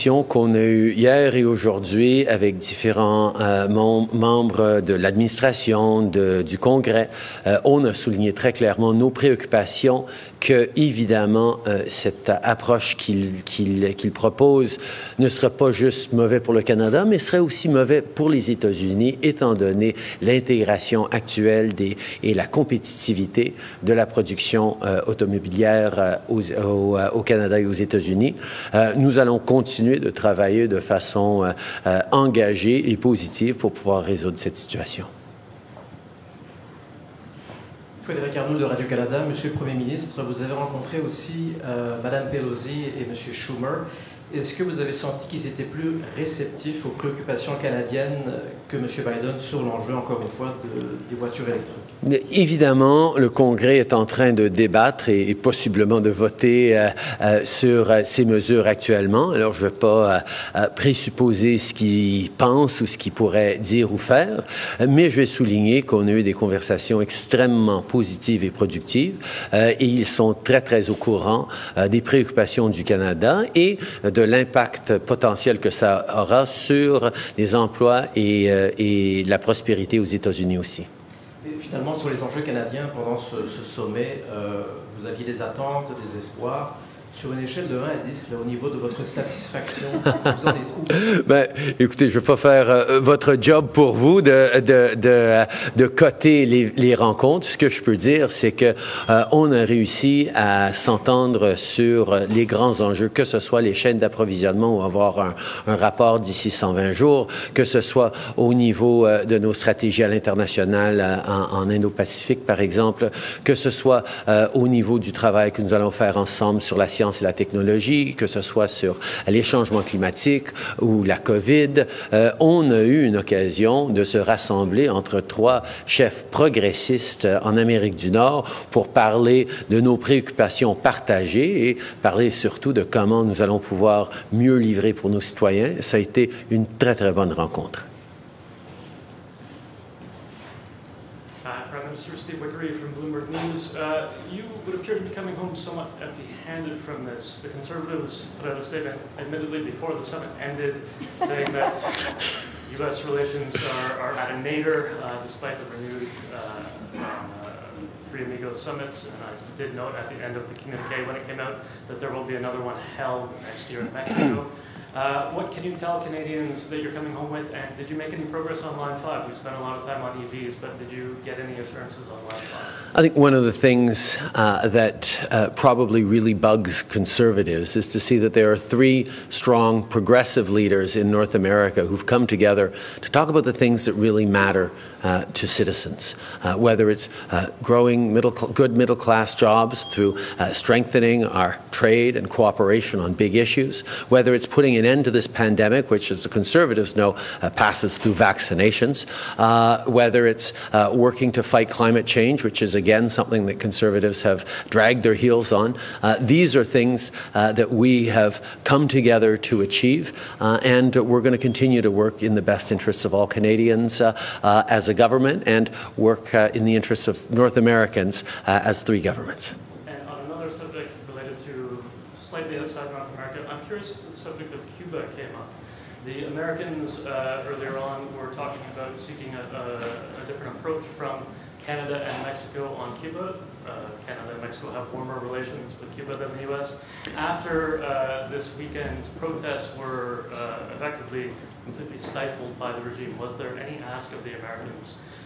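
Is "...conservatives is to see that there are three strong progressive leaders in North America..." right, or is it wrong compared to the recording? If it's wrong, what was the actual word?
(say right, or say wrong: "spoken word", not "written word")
right.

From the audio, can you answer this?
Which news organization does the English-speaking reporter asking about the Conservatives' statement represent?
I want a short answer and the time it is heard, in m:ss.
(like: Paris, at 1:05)
Bloomberg News, at 2:22.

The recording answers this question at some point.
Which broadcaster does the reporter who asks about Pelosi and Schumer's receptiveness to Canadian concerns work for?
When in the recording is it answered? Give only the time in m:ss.
0:38.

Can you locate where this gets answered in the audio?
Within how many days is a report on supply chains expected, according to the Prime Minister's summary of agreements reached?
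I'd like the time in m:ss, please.
1:46.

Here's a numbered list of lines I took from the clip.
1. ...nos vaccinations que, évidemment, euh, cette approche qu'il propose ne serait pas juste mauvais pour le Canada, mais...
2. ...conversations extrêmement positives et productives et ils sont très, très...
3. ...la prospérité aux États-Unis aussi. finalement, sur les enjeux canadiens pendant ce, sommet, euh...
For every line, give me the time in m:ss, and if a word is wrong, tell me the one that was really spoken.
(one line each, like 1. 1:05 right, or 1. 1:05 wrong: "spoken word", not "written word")
1. 0:08 wrong: "préoccupations", not "vaccinations"
2. 1:06 right
3. 1:19 right.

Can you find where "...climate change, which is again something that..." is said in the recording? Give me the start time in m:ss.
3:21.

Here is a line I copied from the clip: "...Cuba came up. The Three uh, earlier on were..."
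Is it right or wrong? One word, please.
wrong.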